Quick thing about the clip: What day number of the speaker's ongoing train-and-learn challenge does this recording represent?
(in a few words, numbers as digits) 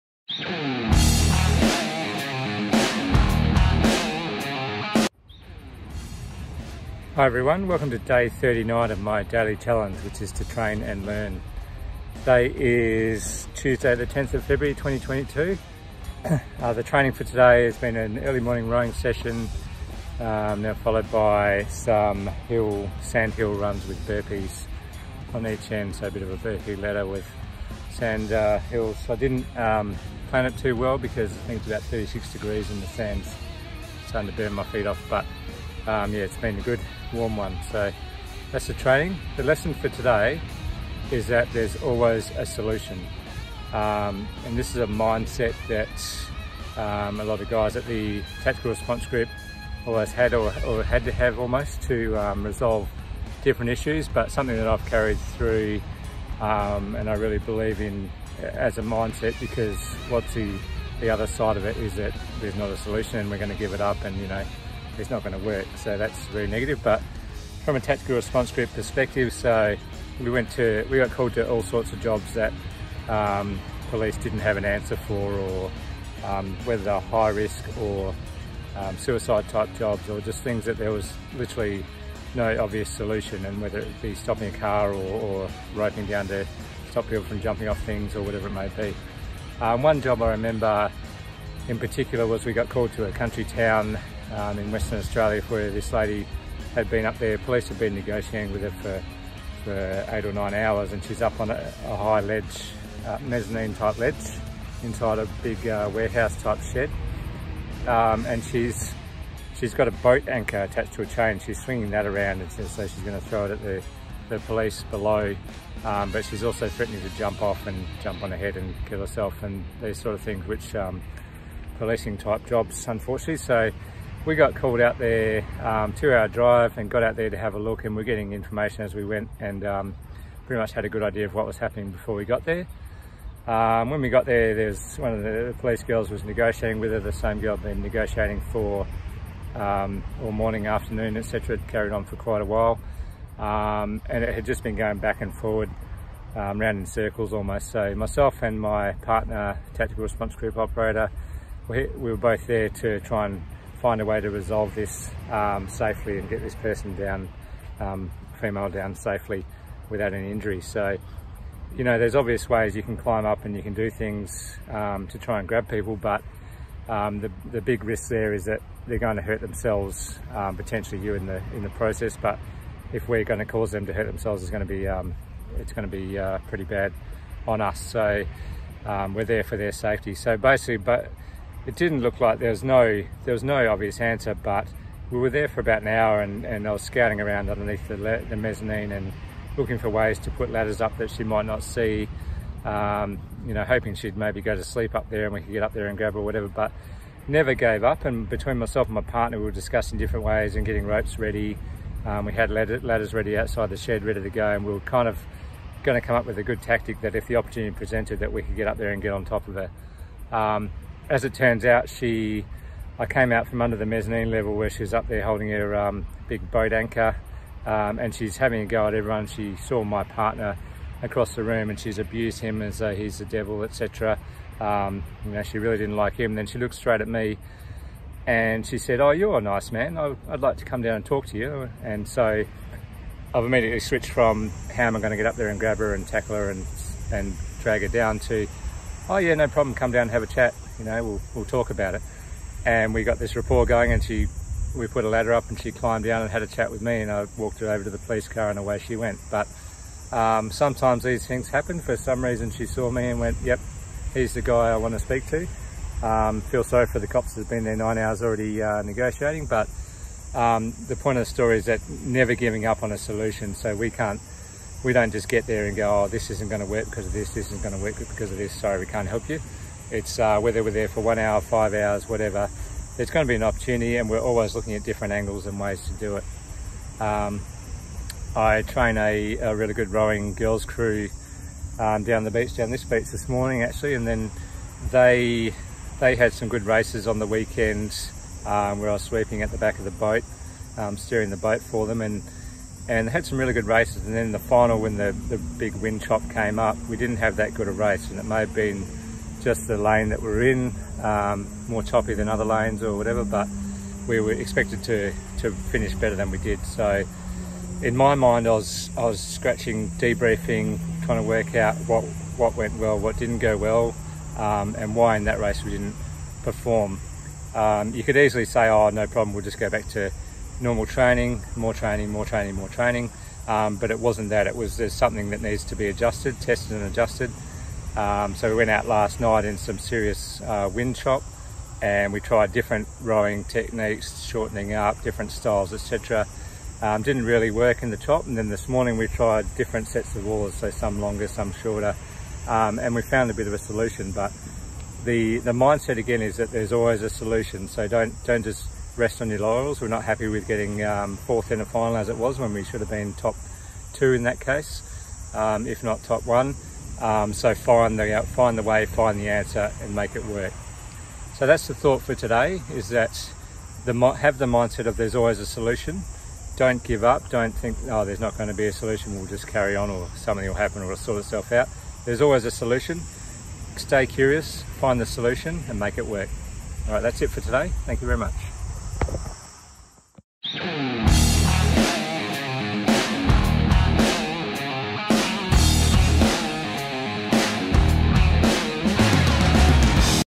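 39.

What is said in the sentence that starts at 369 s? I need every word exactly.
We'll just carry on, or something will happen, or it'll sort itself out.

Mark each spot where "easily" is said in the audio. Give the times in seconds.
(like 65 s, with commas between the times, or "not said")
318 s.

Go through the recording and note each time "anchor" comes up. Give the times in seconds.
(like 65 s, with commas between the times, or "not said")
110 s, 216 s.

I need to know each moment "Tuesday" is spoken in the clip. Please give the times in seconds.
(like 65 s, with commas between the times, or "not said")
13 s.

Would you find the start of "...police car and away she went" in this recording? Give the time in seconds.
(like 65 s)
247 s.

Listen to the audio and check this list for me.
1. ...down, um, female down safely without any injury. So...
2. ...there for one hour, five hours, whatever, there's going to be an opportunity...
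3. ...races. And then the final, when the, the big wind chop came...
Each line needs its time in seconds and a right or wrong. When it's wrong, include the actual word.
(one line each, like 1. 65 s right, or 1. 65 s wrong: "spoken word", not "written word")
1. 156 s right
2. 270 s right
3. 293 s right.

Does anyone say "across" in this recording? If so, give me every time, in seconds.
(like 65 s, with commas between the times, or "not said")
221 s.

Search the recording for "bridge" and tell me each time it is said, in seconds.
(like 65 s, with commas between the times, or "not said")
not said.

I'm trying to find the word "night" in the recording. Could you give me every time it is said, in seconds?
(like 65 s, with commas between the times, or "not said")
329 s.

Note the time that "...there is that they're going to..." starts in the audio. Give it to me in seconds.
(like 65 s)
168 s.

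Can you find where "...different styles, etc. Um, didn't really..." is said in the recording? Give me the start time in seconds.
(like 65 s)
335 s.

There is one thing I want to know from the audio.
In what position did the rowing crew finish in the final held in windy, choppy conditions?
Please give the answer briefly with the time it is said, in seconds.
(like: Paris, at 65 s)
Fourth, at 351 s.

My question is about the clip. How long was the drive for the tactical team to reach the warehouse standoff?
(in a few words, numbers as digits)
2 hours.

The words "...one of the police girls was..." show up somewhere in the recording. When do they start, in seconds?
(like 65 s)
134 s.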